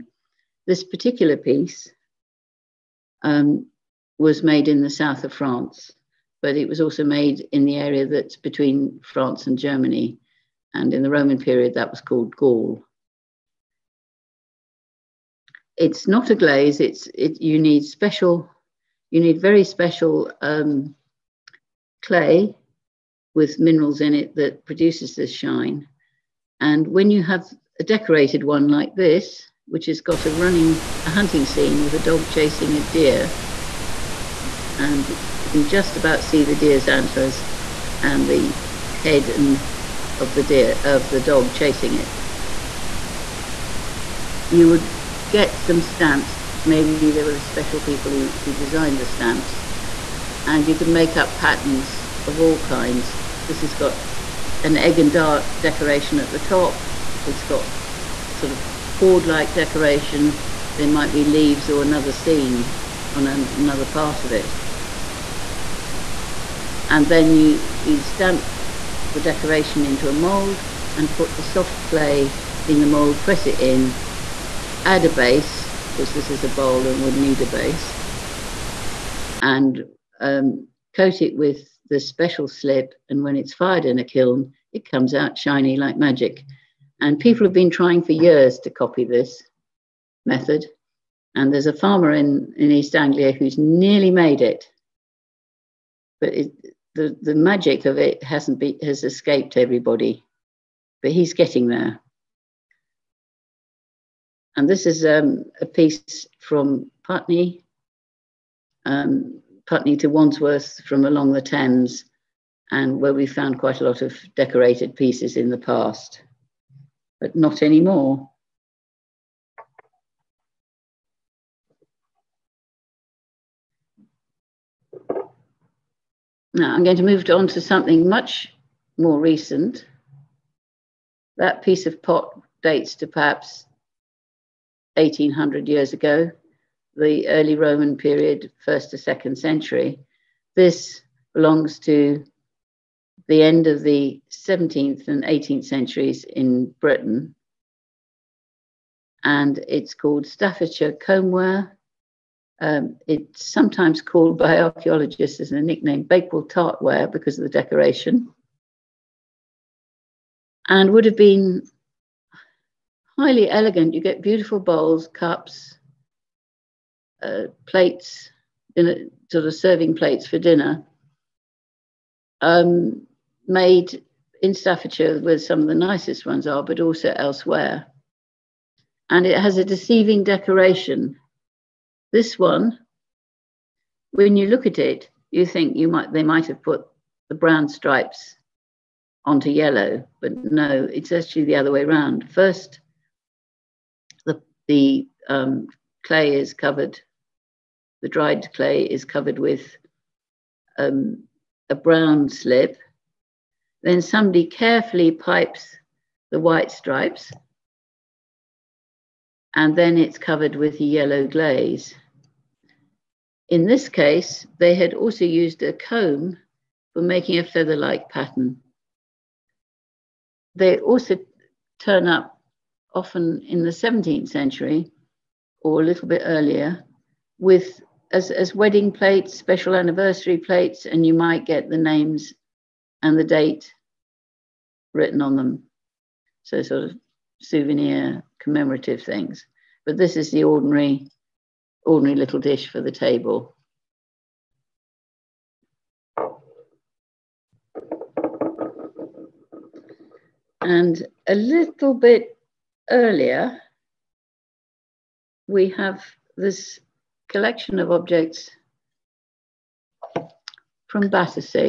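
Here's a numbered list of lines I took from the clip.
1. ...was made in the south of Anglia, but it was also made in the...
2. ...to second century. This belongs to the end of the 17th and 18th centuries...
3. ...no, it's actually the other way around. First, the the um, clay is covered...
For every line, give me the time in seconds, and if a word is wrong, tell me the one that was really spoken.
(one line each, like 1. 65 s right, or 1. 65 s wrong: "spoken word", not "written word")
1. 4 s wrong: "France", not "Anglia"
2. 138 s right
3. 190 s right.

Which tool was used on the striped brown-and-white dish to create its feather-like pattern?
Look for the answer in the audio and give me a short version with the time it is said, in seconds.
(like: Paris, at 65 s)
A comb, at 215 s.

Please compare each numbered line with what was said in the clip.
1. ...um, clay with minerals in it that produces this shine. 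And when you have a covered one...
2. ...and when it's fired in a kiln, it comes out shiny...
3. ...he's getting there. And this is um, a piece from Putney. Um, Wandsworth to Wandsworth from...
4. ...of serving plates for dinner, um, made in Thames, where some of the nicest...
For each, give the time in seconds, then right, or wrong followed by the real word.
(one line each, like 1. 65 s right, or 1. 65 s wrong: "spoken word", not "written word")
1. 20 s wrong: "decorated", not "covered"
2. 83 s right
3. 101 s wrong: "Putney", not "Wandsworth"
4. 169 s wrong: "Staffordshire", not "Thames".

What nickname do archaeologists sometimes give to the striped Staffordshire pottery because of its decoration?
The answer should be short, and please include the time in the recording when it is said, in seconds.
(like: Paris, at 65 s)
Bakewell tartware, at 156 s.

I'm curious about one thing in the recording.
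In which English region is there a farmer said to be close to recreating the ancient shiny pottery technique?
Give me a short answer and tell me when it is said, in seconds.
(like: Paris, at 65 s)
East Anglia, at 92 s.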